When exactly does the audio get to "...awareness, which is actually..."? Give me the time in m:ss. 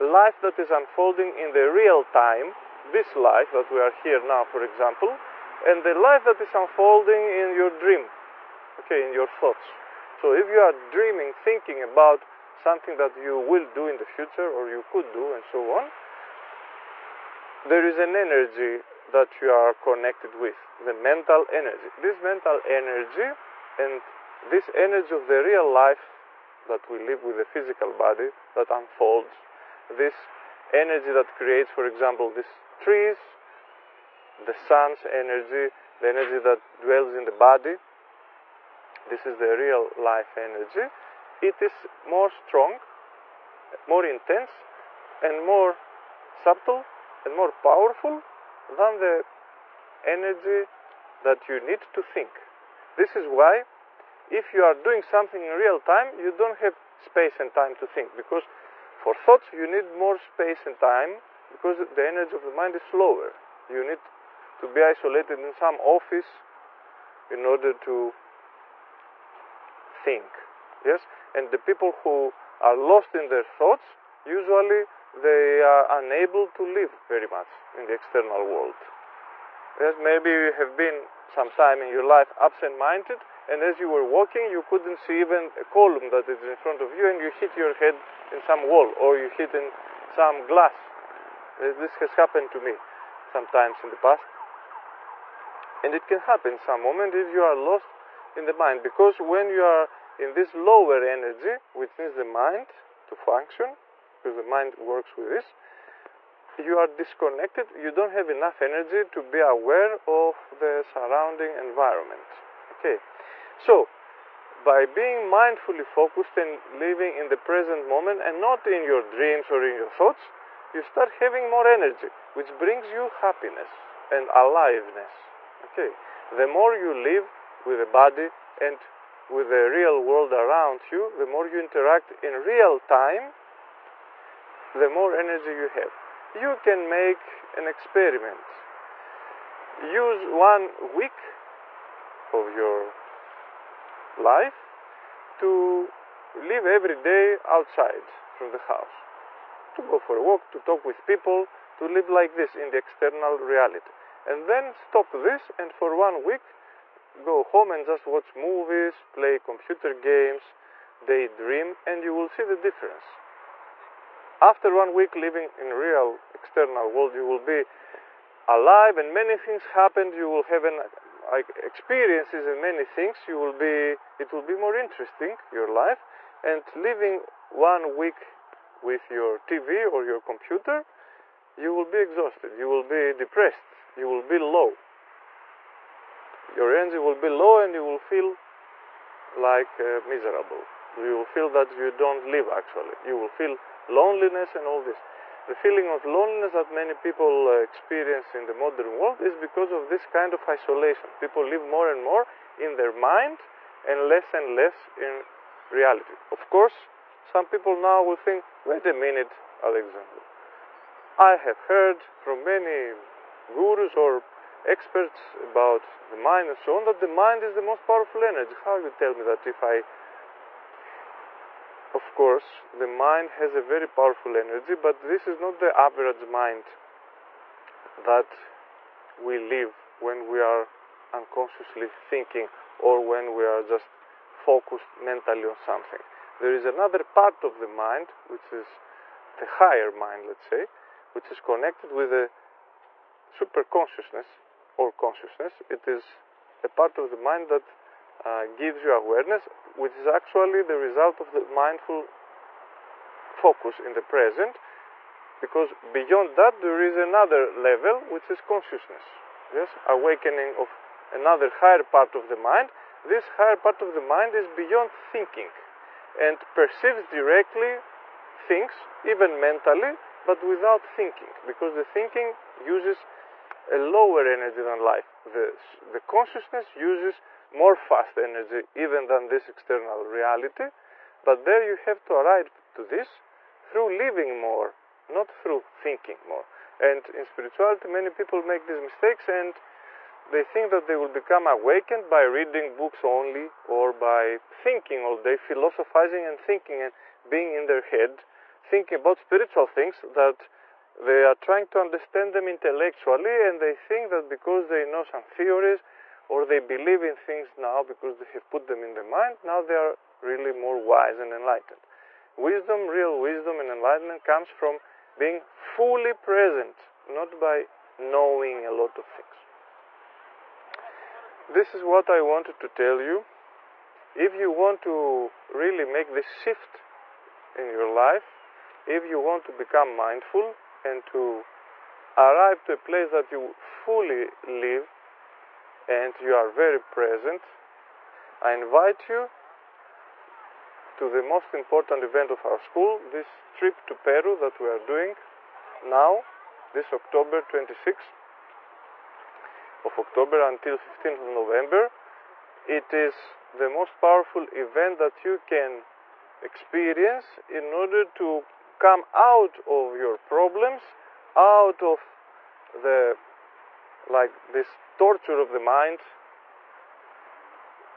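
4:08.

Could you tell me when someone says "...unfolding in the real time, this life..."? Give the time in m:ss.
0:00.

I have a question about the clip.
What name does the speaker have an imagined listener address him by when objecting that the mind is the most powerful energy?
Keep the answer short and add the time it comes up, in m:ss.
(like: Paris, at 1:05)
Alexander, at 3:29.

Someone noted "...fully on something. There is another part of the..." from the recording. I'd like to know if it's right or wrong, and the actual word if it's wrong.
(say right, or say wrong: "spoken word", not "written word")
wrong: "mentally", not "fully".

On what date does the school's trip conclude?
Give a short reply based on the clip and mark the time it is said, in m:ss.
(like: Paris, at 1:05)
November 15, at 5:50.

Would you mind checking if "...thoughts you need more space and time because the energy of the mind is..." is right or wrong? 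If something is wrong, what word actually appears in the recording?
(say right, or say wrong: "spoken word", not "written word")
right.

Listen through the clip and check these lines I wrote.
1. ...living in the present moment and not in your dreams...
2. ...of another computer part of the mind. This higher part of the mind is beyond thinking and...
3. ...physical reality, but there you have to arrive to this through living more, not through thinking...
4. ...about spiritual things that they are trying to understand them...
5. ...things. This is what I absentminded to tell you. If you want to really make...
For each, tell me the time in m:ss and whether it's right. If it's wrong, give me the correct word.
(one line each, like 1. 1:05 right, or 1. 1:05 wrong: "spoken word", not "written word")
1. 1:56 right
2. 4:20 wrong: "higher", not "computer"
3. 4:39 wrong: "external", not "physical"
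4. 4:58 right
5. 5:19 wrong: "wanted", not "absentminded".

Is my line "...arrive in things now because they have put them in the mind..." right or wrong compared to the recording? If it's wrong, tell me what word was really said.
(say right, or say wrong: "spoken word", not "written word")
wrong: "believe", not "arrive".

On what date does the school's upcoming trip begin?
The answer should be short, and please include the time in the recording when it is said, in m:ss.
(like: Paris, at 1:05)
October 26, at 5:47.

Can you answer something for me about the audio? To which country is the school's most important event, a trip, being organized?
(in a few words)
Peru.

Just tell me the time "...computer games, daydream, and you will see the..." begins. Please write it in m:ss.
2:39.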